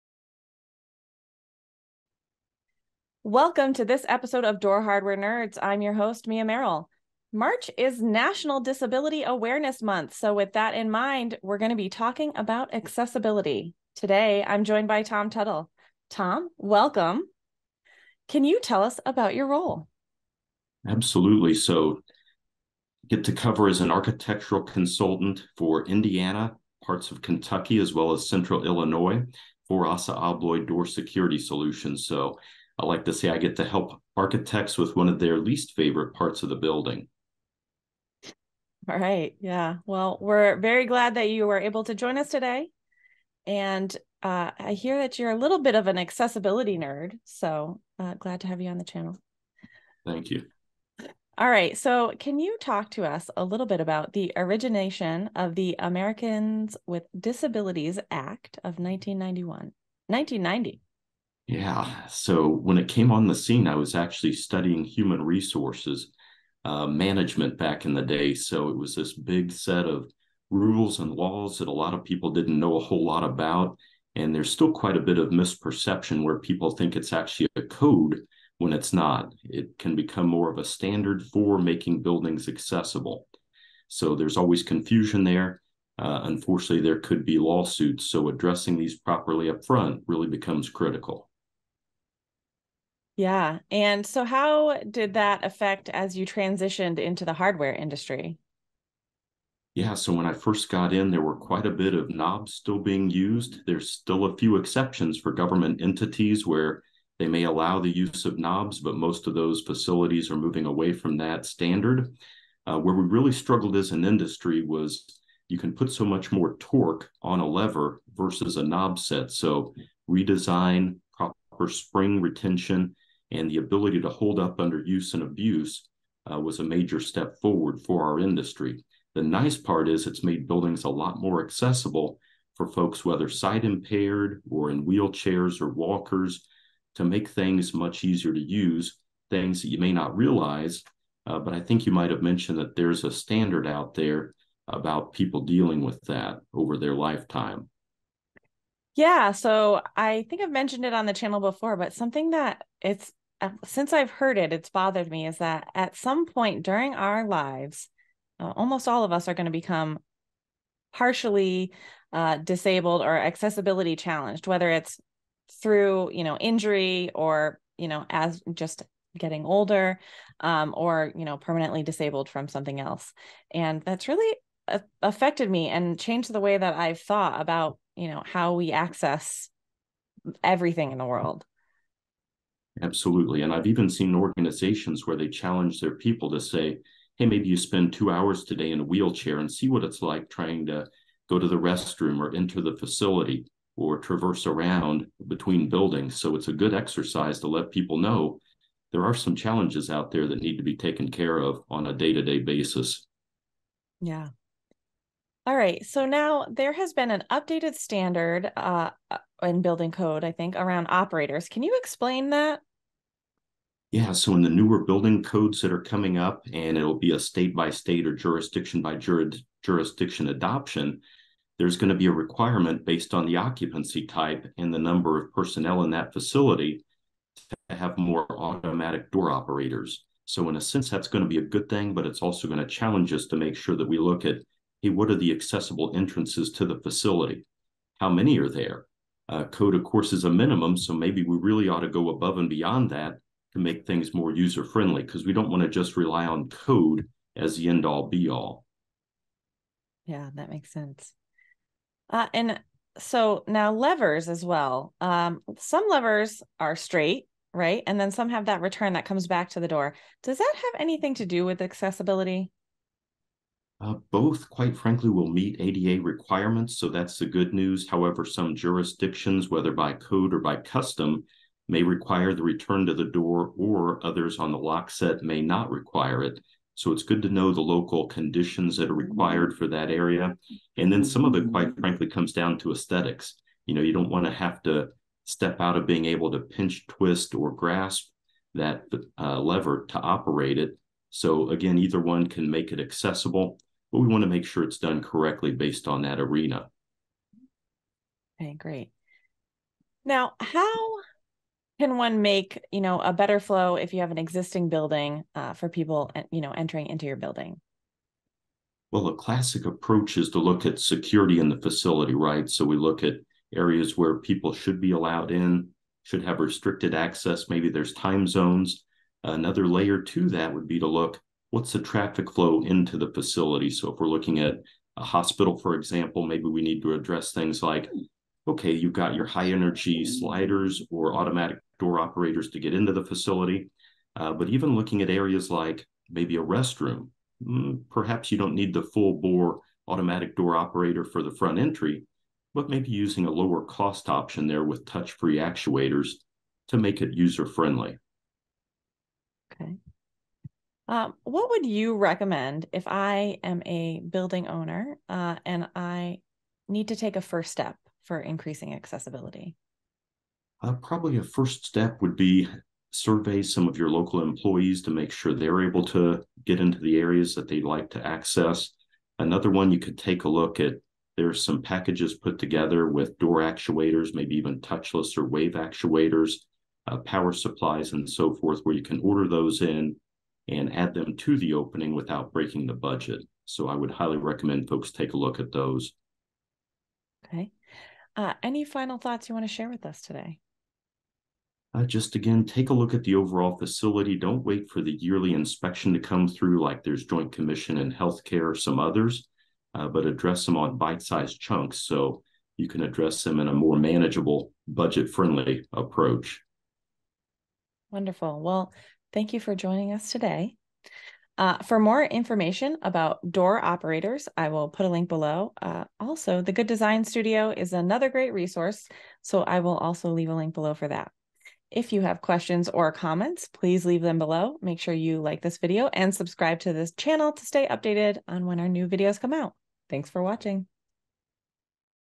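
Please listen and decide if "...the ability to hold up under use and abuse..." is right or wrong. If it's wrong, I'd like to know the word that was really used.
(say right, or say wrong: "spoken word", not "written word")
right.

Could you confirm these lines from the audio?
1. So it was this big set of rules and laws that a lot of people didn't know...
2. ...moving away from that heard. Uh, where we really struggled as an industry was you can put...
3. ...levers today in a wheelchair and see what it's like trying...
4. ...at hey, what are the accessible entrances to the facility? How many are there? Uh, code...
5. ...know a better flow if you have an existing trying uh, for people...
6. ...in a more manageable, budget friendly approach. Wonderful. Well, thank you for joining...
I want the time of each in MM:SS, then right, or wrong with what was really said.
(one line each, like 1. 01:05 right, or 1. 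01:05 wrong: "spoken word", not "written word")
1. 01:08 right
2. 01:50 wrong: "standard", not "heard"
3. 03:08 wrong: "hours", not "levers"
4. 03:54 right
5. 05:02 wrong: "building", not "trying"
6. 06:43 right.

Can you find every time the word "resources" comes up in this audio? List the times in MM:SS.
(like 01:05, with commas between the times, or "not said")
01:05, 06:58.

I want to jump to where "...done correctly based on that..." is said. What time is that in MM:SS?
04:54.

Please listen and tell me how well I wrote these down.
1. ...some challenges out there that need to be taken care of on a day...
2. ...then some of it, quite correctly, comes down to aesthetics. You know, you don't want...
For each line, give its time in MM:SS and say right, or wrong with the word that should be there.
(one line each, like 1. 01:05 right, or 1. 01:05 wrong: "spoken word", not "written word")
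1. 03:19 right
2. 04:40 wrong: "frankly", not "correctly".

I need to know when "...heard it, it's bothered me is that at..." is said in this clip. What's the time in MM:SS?
02:34.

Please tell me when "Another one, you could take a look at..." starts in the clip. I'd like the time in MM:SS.
06:09.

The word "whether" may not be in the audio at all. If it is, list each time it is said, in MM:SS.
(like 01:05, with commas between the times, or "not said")
02:13, 02:44, 04:29.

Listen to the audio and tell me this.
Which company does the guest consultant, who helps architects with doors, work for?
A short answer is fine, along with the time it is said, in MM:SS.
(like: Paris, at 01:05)
ASSA ABLOY Door Security Solutions, at 00:29.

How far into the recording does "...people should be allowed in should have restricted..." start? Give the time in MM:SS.
05:14.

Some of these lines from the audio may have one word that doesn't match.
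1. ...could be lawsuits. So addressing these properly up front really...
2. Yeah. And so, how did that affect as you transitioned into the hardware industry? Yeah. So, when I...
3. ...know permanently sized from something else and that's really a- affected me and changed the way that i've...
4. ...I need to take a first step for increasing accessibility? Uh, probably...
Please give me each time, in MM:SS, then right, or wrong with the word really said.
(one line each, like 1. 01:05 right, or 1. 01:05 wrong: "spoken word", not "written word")
1. 01:26 right
2. 01:33 right
3. 02:51 wrong: "disabled", not "sized"
4. 05:55 right.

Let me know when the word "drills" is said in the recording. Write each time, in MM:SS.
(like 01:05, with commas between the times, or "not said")
not said.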